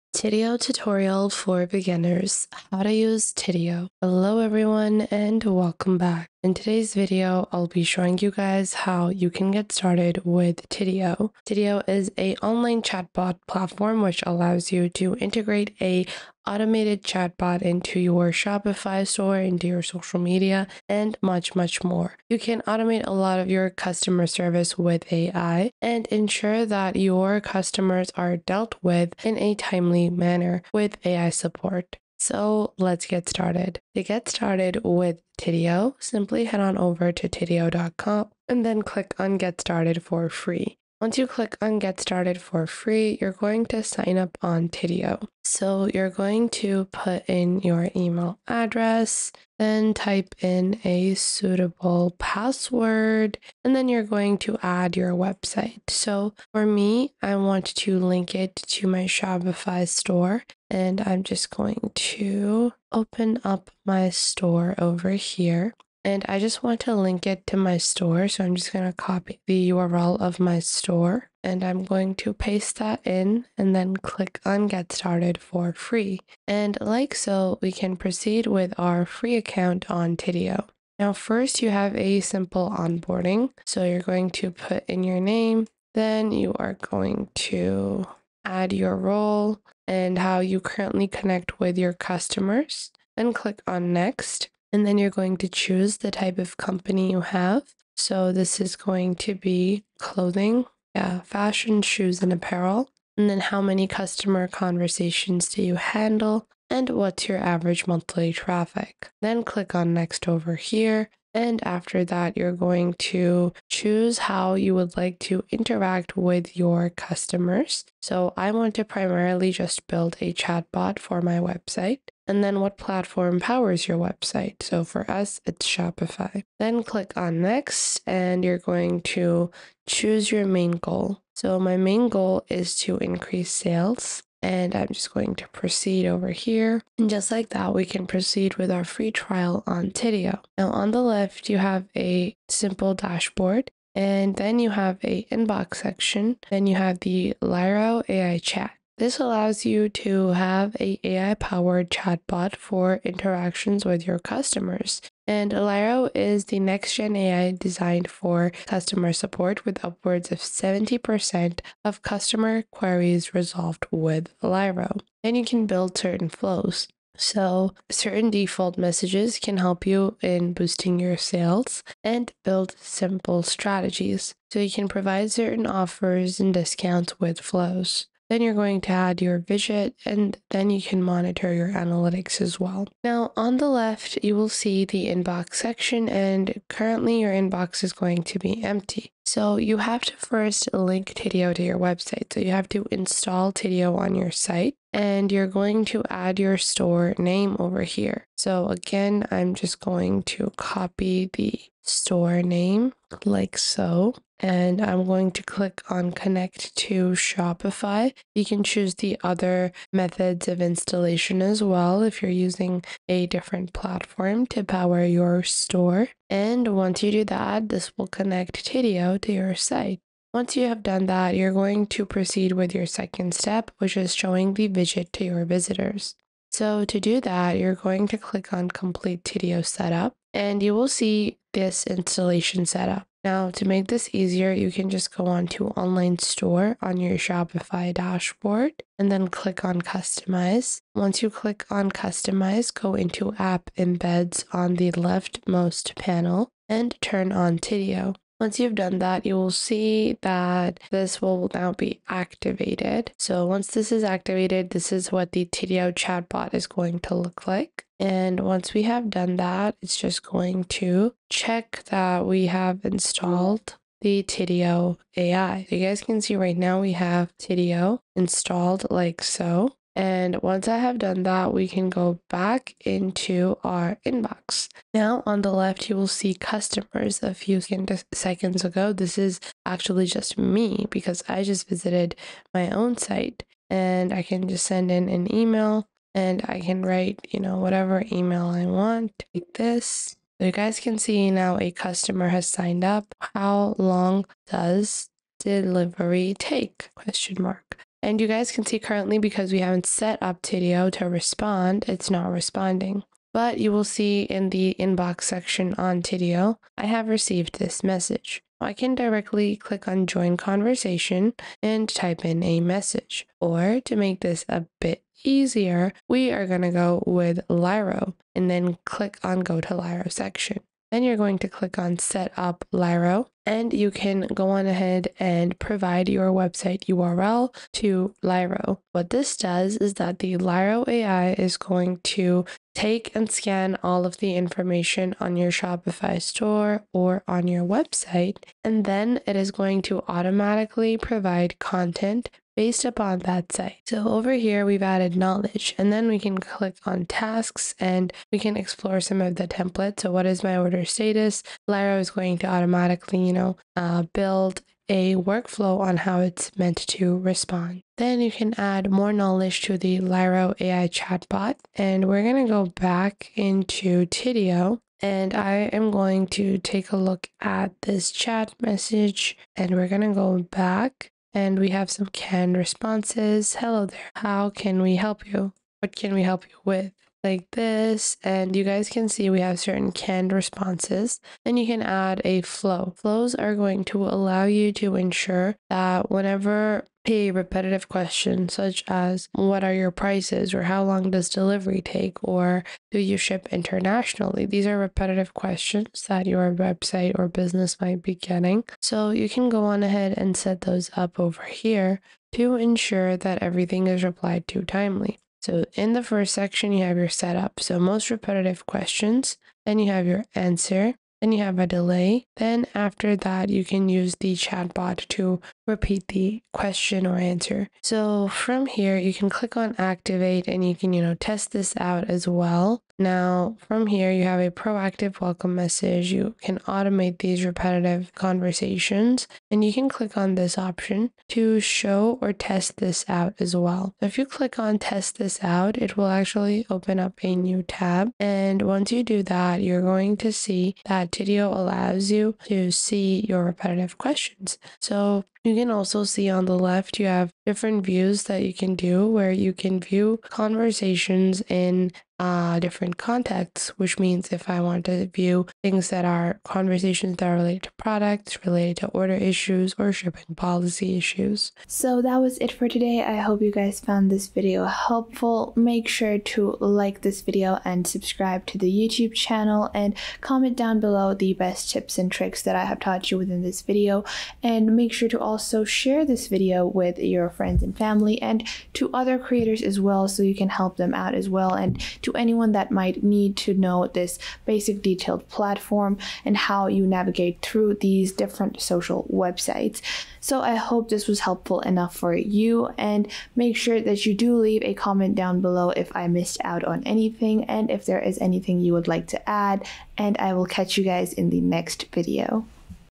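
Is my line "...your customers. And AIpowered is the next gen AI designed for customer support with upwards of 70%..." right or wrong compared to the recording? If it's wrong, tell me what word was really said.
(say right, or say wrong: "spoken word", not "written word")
wrong: "Alero", not "AIpowered".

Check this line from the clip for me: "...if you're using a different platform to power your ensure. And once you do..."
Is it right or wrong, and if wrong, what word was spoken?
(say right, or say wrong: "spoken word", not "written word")
wrong: "store", not "ensure".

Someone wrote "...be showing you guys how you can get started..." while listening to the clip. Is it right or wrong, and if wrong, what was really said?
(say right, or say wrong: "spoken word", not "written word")
right.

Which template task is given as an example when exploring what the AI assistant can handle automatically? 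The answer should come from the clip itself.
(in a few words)
What is my order status?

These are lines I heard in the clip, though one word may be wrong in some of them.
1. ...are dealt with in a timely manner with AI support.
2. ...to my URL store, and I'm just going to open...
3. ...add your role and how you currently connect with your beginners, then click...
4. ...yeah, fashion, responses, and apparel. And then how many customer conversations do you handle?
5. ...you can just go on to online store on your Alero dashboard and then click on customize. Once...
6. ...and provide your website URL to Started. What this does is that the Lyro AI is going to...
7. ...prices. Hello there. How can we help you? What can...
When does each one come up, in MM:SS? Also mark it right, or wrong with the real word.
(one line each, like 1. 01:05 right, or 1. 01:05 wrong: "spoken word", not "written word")
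1. 00:28 right
2. 00:58 wrong: "Shopify", not "URL"
3. 01:28 wrong: "customers", not "beginners"
4. 01:40 wrong: "shoes", not "responses"
5. 03:54 wrong: "Shopify", not "Alero"
6. 05:25 wrong: "Lyro", not "Started"
7. 06:12 wrong: "responses", not "prices".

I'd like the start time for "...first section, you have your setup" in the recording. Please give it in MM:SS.
06:46.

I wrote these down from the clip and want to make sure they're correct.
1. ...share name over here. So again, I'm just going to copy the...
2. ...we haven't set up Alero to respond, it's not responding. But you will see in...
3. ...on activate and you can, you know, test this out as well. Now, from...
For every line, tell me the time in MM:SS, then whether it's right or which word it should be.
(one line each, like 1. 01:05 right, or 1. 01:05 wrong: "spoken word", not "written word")
1. 03:16 wrong: "store", not "share"
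2. 04:59 wrong: "Tidio", not "Alero"
3. 06:59 right.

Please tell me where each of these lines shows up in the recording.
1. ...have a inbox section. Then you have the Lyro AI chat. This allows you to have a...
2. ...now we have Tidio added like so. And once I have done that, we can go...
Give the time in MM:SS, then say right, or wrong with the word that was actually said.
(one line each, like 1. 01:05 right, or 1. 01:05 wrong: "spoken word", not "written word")
1. 02:24 right
2. 04:26 wrong: "installed", not "added".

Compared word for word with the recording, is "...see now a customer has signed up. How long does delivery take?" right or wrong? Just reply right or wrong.
right.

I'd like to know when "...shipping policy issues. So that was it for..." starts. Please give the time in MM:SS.
07:39.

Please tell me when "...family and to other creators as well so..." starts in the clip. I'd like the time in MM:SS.
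07:57.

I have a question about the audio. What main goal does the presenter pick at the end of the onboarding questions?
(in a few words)
Increase sales.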